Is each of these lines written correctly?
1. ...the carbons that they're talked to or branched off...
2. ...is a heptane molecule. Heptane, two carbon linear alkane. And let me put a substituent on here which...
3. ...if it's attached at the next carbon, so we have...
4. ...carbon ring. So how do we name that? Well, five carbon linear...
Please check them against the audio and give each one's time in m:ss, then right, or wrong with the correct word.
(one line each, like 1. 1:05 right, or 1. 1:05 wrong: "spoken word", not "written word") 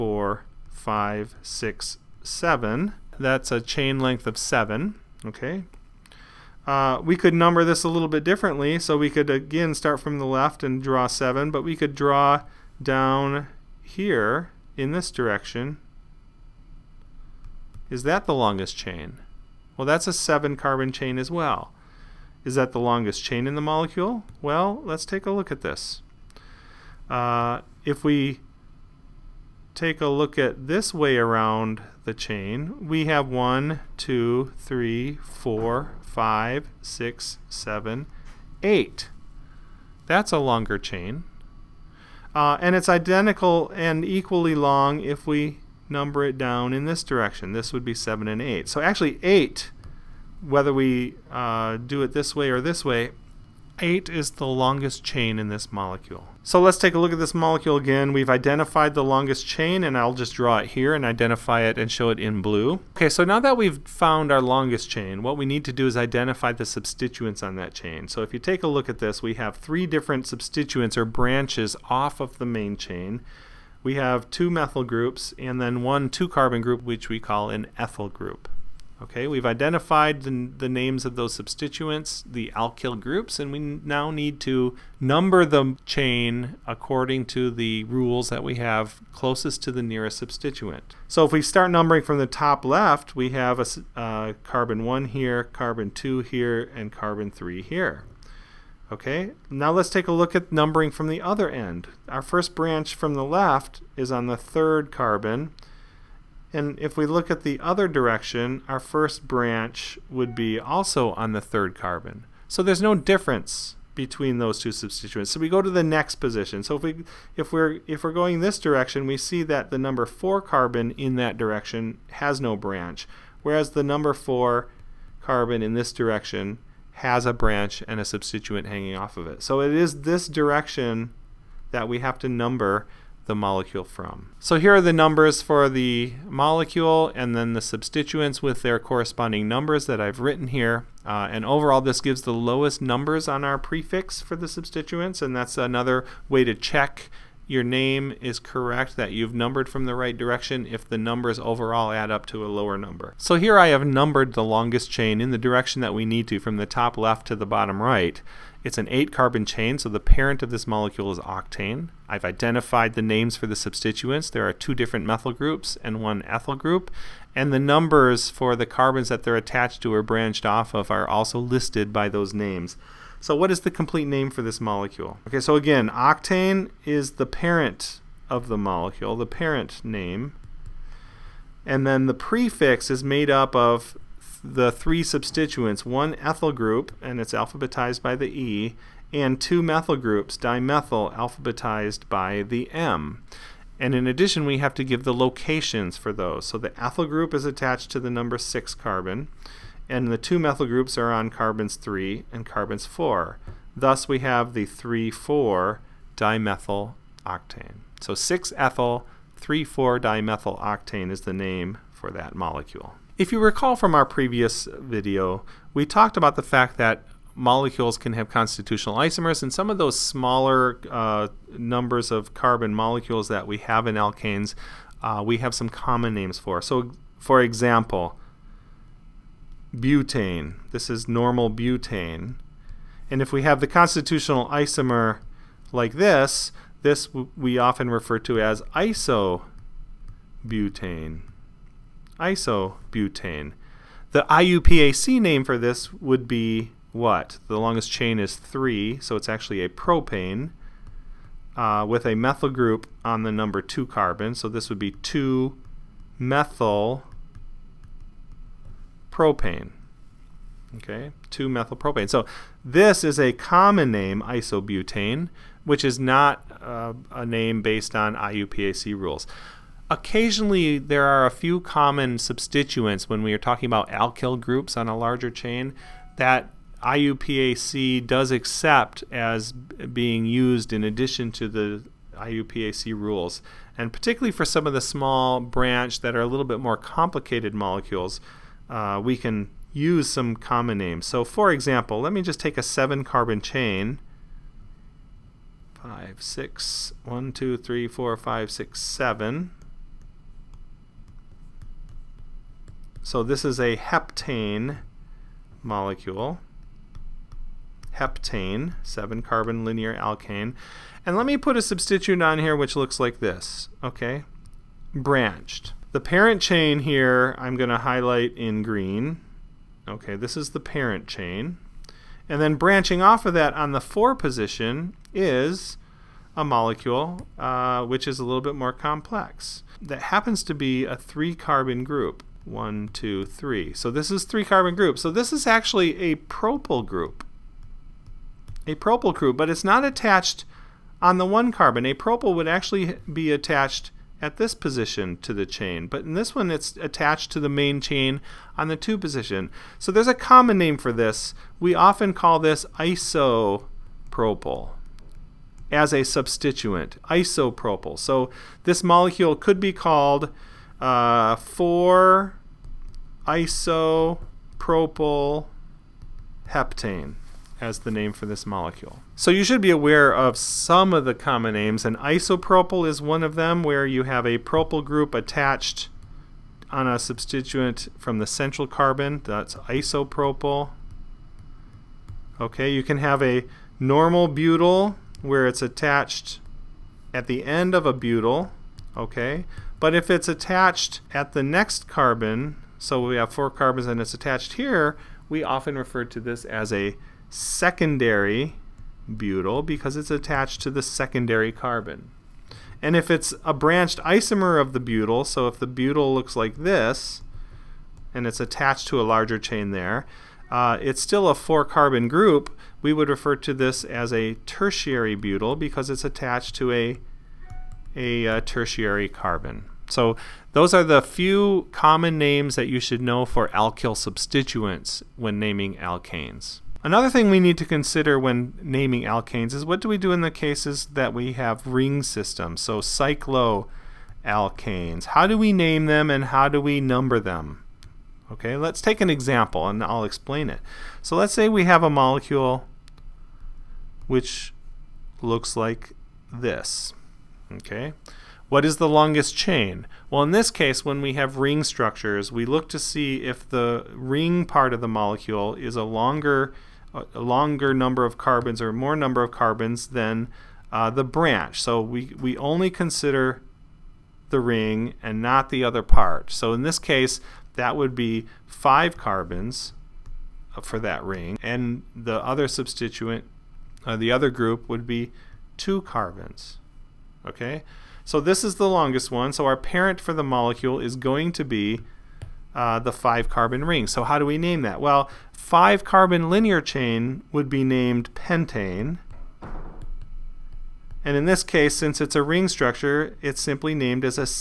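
1. 2:48 wrong: "attached", not "talked"
2. 5:03 wrong: "seven", not "two"
3. 6:29 right
4. 8:03 right.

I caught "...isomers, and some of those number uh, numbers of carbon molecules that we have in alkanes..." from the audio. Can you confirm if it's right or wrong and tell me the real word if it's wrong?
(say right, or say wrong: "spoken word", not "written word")
wrong: "smaller", not "number".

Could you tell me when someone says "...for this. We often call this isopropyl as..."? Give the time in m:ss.
5:50.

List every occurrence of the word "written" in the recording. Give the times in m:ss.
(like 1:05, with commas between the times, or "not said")
2:20.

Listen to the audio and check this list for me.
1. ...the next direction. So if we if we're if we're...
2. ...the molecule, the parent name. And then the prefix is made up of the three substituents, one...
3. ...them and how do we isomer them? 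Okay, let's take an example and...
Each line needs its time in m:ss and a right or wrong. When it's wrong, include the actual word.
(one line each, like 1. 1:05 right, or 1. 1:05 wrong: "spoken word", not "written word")
1. 1:55 wrong: "position", not "direction"
2. 2:58 right
3. 7:15 wrong: "number", not "isomer".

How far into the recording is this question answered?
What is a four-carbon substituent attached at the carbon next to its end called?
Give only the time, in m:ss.
6:37.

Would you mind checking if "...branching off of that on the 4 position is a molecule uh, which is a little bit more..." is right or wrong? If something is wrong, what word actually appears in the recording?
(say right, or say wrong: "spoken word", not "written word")
right.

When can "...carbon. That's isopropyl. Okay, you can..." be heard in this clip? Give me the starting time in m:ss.
6:18.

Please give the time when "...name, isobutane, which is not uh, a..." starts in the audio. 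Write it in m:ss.
4:23.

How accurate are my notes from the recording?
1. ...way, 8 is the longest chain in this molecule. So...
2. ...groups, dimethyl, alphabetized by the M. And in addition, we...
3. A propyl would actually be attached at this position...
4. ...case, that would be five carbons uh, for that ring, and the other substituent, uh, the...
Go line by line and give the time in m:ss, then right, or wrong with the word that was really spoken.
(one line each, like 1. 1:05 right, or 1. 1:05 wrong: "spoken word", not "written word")
1. 0:52 right
2. 3:09 right
3. 5:41 right
4. 7:46 right.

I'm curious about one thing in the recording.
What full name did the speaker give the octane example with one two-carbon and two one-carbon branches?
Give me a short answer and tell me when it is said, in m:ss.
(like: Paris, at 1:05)
6-ethyl-3,4-dimethyloctane, at 3:28.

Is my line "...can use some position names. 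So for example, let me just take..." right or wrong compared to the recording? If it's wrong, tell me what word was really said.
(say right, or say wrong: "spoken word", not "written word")
wrong: "common", not "position".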